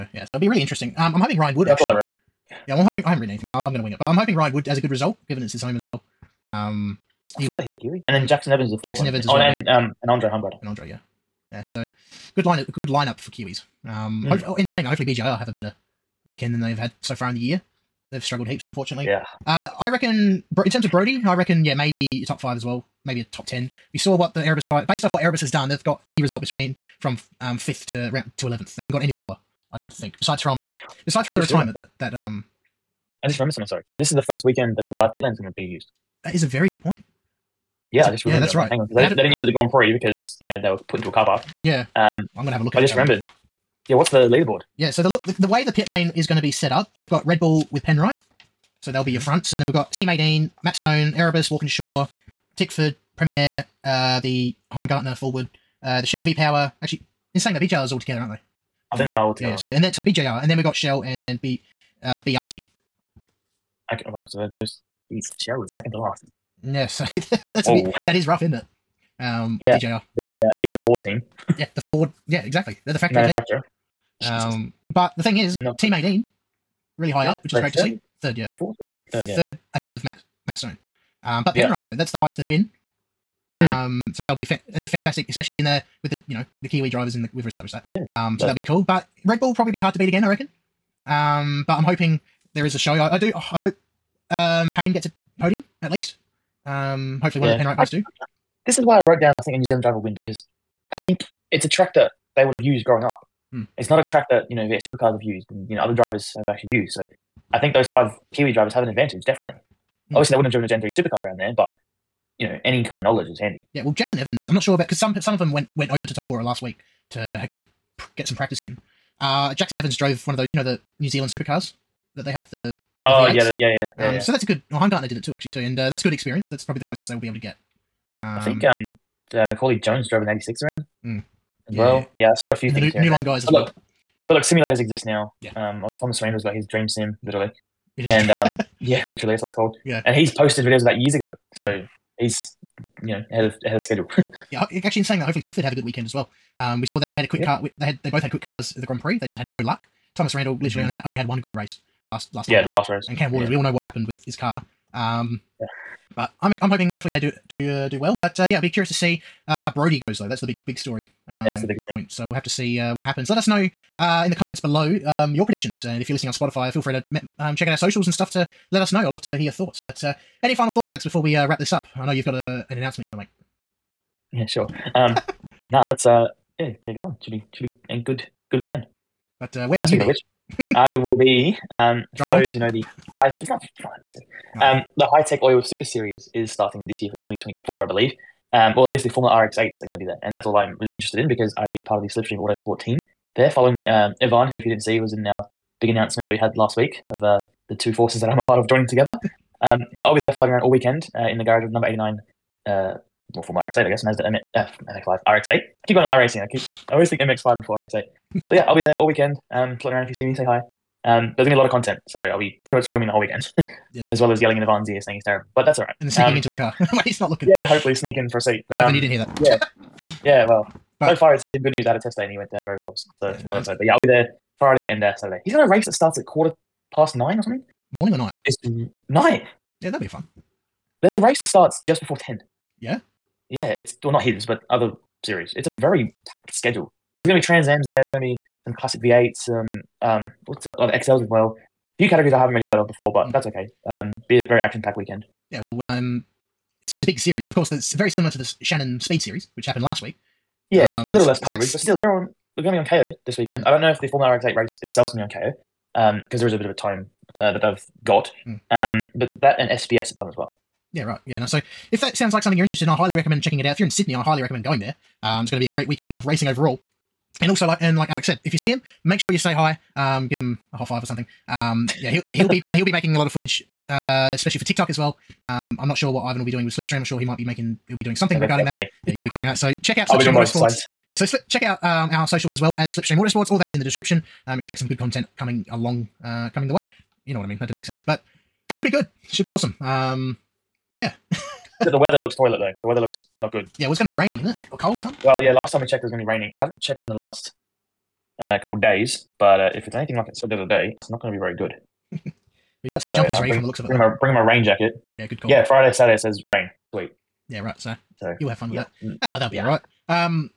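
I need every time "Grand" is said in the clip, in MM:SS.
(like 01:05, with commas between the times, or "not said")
00:39, 02:28.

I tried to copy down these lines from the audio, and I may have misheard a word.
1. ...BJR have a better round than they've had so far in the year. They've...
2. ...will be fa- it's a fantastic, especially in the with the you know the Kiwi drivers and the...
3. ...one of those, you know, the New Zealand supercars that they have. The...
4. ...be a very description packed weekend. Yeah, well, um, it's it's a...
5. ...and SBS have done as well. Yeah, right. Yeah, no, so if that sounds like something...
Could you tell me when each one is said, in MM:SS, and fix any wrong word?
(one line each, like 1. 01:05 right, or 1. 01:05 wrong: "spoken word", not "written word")
1. 00:15 wrong: "weekend", not "round"
2. 01:24 right
3. 02:00 right
4. 04:04 wrong: "action", not "description"
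5. 04:19 right.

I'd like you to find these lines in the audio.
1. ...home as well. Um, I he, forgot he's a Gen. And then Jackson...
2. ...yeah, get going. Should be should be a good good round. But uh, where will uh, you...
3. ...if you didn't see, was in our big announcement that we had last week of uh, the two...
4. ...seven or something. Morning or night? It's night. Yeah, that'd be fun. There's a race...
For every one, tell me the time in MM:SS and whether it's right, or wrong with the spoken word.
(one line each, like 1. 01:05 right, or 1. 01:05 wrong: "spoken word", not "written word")
1. 00:05 wrong: "Kiwi", not "Gen"
2. 02:56 wrong: "weekend", not "round"
3. 03:14 right
4. 03:47 wrong: "nine", not "seven".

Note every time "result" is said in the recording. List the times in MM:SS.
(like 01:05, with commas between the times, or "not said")
00:04, 00:26.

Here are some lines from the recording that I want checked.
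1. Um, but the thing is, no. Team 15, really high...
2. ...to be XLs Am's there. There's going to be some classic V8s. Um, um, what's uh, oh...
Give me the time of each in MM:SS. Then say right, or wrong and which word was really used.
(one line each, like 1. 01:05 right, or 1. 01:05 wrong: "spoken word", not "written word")
1. 01:14 wrong: "18", not "15"
2. 03:57 wrong: "Trans", not "XLs".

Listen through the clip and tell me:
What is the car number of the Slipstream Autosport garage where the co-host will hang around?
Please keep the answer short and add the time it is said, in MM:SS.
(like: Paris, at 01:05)
89, at 03:21.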